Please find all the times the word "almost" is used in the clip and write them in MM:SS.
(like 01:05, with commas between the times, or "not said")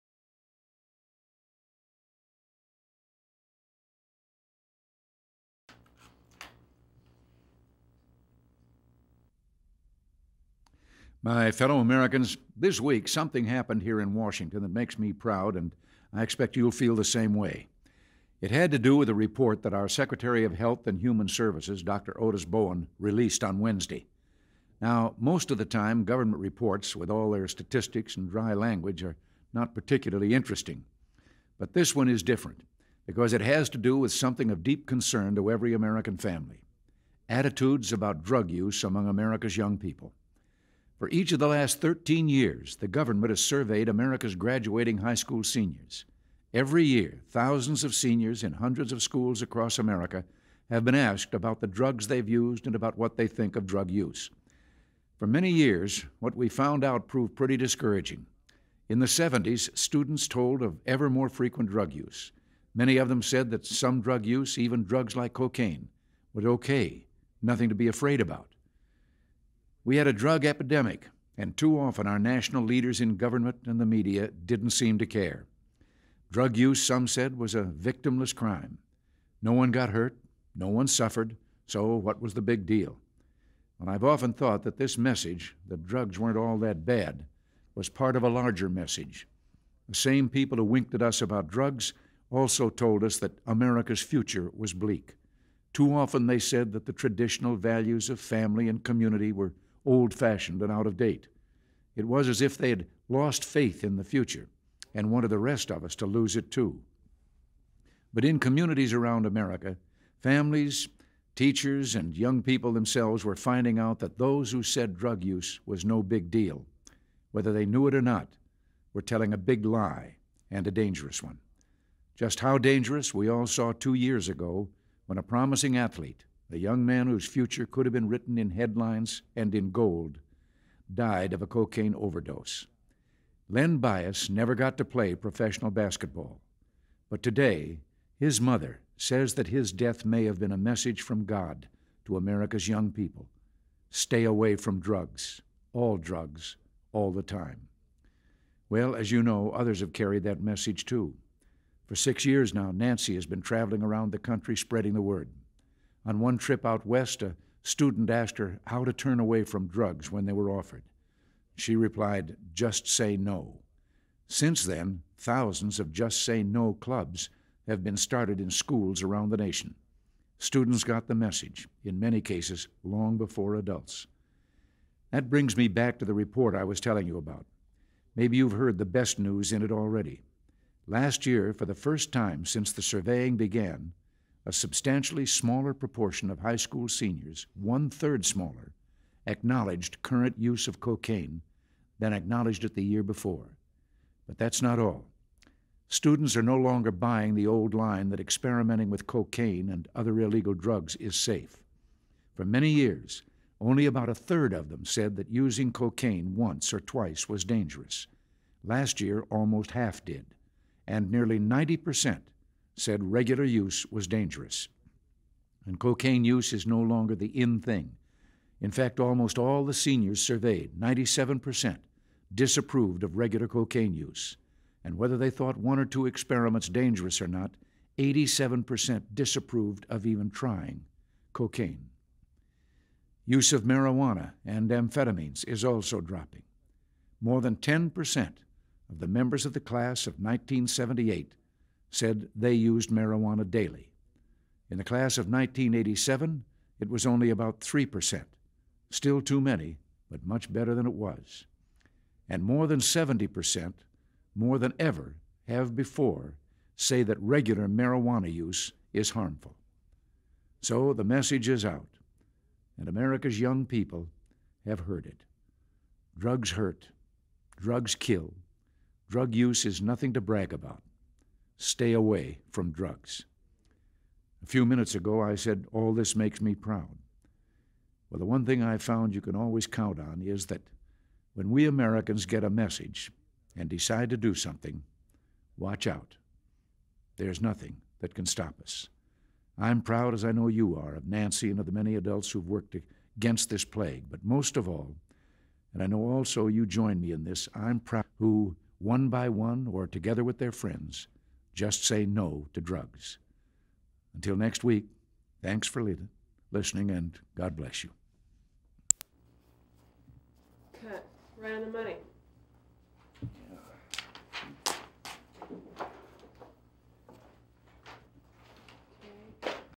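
03:29, 03:38.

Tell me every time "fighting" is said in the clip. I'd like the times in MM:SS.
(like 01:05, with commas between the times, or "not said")
not said.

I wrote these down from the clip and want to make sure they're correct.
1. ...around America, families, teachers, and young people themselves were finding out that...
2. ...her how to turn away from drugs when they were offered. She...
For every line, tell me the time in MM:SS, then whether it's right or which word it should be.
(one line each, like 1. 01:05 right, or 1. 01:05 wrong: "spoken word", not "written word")
1. 01:48 right
2. 02:38 right.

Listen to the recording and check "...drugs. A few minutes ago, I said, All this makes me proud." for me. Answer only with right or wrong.
right.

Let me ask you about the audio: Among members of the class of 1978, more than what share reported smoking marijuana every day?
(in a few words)
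10%.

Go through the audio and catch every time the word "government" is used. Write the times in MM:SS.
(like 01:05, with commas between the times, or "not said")
00:26, 00:42, 01:13.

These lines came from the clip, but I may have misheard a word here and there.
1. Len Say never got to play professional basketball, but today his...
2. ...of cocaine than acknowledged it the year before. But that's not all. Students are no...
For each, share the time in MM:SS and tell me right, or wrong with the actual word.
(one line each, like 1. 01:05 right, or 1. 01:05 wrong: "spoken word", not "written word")
1. 02:13 wrong: "Bias", not "Say"
2. 03:10 right.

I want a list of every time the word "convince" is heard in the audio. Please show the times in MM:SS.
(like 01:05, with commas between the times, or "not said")
not said.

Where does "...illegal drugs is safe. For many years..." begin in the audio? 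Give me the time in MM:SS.
03:20.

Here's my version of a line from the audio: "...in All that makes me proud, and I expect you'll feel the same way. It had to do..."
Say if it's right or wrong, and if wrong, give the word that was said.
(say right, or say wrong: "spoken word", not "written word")
wrong: "Washington", not "All".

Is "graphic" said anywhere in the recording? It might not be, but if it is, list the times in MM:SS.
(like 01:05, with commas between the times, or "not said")
not said.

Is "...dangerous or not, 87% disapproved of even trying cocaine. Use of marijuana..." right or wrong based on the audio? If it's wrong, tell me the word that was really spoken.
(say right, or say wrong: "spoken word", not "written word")
right.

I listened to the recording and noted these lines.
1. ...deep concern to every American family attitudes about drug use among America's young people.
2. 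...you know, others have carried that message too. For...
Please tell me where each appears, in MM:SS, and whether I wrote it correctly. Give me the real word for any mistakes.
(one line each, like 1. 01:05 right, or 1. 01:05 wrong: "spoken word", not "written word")
1. 00:34 right
2. 02:29 right.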